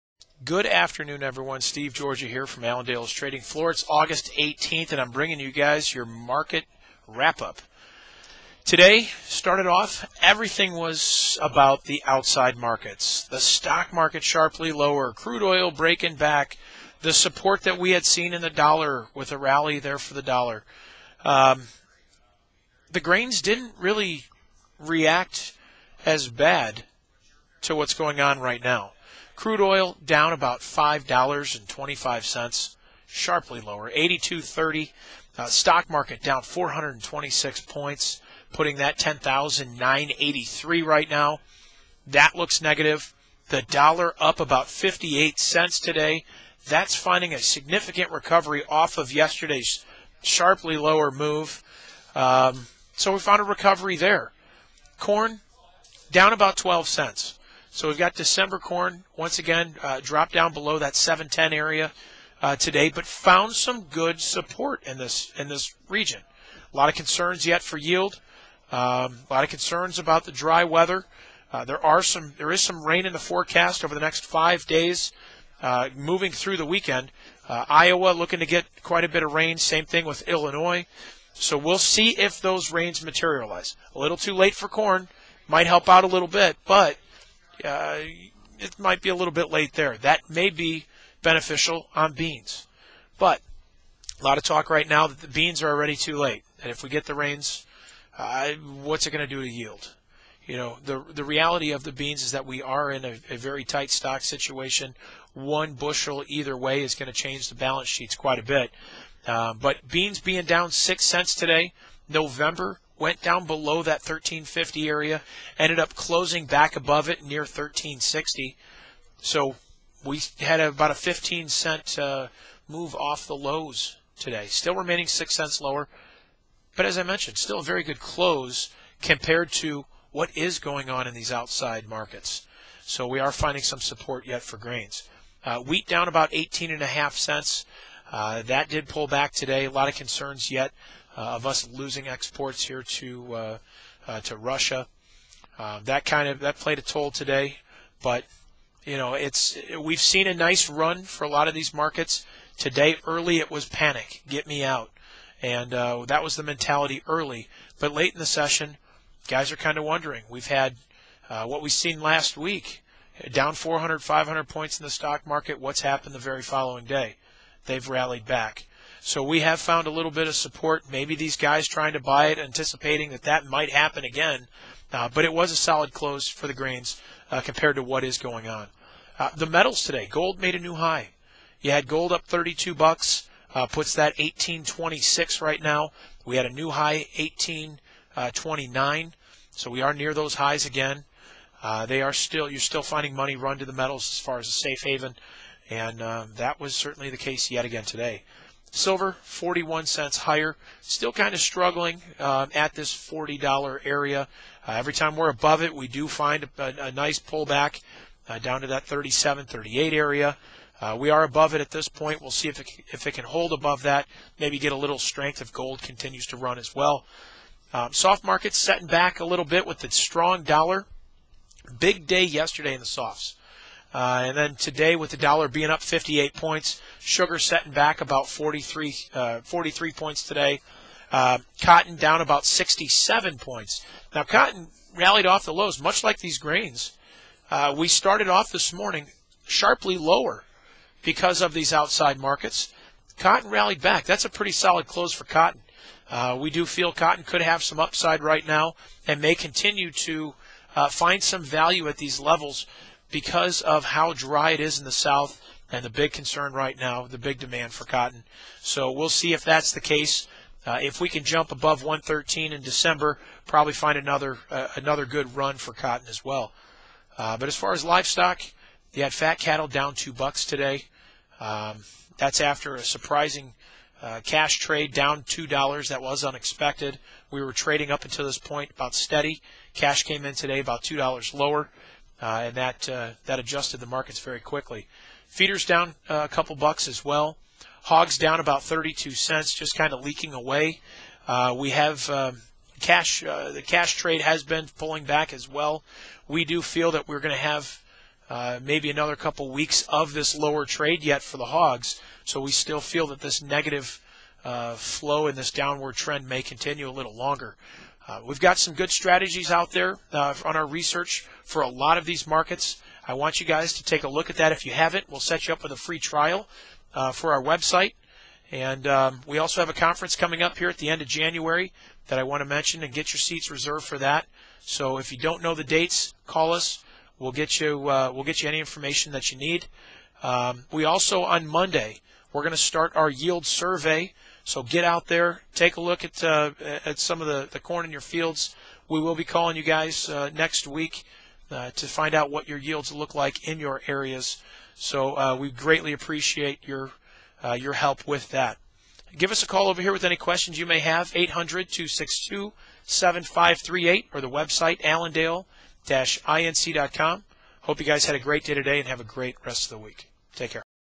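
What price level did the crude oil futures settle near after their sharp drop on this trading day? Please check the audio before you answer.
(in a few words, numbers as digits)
82.30.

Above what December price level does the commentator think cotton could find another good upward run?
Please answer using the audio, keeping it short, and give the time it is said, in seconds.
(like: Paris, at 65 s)
113, at 261 s.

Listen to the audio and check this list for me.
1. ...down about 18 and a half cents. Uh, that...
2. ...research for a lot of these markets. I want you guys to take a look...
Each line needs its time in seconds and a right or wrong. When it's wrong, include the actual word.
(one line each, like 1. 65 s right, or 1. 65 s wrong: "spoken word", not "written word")
1. 135 s right
2. 310 s right.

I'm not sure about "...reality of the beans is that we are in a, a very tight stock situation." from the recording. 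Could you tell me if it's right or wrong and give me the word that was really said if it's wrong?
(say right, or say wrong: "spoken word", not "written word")
right.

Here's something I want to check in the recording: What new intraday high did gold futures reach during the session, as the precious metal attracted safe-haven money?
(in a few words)
1829.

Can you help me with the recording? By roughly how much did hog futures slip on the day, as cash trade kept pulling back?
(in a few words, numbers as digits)
32 cents.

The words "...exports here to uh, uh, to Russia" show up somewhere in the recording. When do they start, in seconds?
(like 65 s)
142 s.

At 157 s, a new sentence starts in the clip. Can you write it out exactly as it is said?
But late in the session, guys are kind of wondering.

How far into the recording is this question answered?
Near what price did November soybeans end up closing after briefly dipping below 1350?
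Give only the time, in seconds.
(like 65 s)
117 s.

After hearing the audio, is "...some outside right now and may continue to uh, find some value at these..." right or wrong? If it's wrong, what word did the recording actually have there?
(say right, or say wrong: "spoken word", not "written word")
wrong: "upside", not "outside".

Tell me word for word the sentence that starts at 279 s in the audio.
Cash came in today about two dollars lower uh, and that uh, that adjusted the markets very quickly.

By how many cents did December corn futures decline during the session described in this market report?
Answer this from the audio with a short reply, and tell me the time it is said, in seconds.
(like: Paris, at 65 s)
12 cents, at 56 s.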